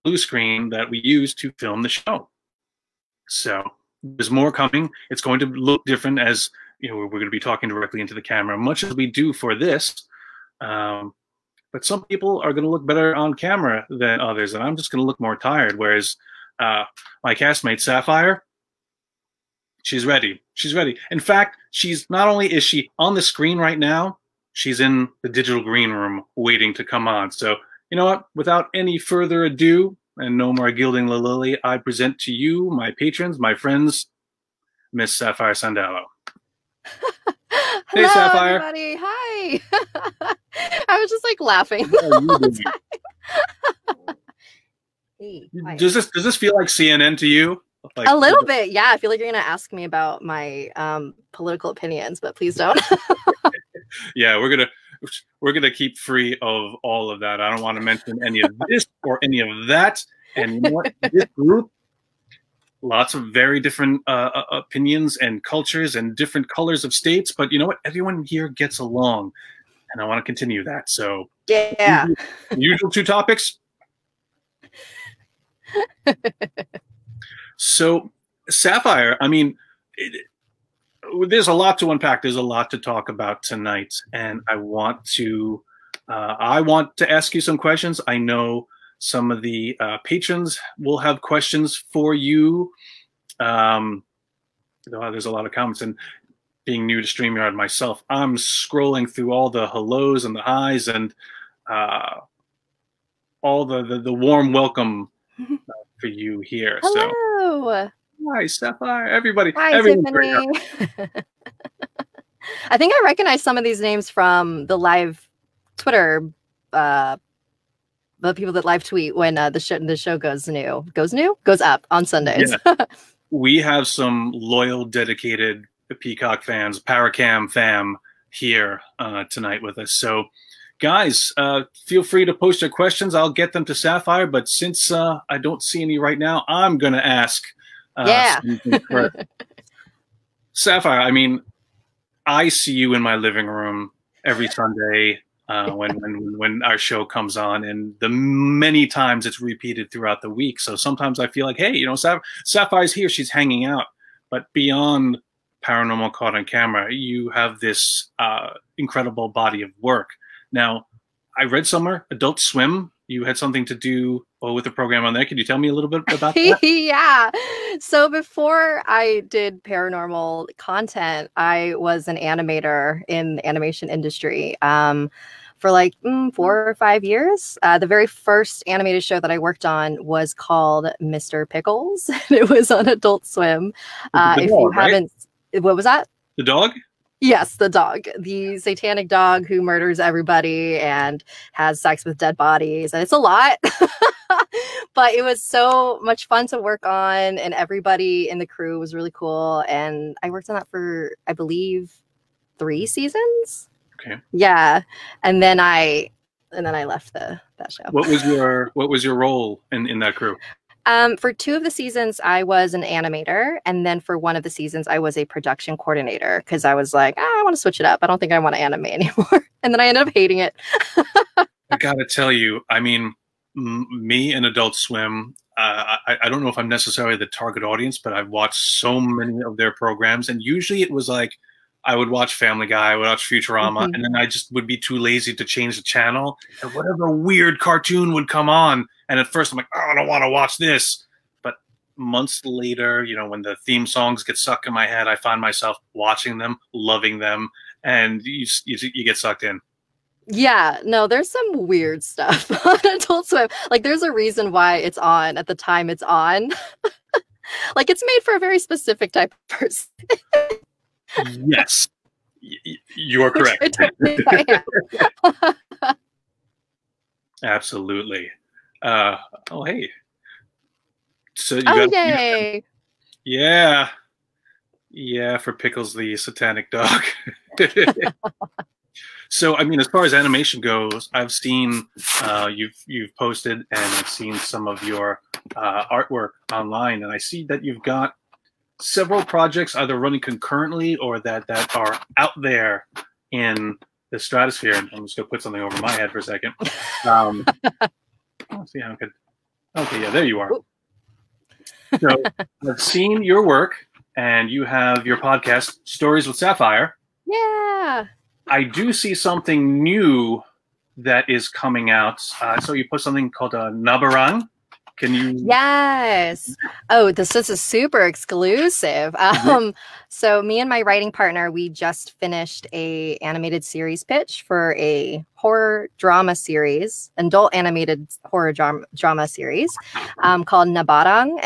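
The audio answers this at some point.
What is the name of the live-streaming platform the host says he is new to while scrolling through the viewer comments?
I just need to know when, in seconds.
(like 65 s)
97 s.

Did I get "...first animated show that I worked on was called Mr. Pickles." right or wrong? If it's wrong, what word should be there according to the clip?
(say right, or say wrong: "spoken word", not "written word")
right.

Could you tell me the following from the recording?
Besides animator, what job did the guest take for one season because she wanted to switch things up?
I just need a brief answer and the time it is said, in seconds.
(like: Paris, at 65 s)
production coordinator, at 215 s.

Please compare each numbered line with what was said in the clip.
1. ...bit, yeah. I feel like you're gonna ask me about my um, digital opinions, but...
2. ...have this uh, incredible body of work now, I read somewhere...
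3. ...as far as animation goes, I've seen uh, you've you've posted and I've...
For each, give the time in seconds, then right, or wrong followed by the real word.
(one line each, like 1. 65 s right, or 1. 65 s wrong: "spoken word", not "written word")
1. 48 s wrong: "political", not "digital"
2. 157 s right
3. 279 s right.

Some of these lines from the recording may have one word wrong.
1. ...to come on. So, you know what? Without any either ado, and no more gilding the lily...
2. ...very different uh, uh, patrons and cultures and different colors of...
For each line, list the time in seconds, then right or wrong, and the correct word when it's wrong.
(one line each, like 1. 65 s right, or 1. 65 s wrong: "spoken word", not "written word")
1. 26 s wrong: "further", not "either"
2. 63 s wrong: "opinions", not "patrons".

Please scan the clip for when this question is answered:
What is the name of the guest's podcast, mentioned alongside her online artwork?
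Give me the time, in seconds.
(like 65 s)
305 s.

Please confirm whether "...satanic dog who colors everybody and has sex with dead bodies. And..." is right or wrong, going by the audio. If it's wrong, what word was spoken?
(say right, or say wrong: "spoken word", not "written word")
wrong: "murders", not "colors".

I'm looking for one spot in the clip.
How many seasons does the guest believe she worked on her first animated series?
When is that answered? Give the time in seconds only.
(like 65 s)
202 s.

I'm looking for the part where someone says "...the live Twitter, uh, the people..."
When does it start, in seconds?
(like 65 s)
114 s.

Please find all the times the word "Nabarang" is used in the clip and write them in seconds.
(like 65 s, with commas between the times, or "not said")
313 s, 330 s.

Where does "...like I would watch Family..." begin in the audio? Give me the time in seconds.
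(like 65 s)
231 s.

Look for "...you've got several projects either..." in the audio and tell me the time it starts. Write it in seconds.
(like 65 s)
287 s.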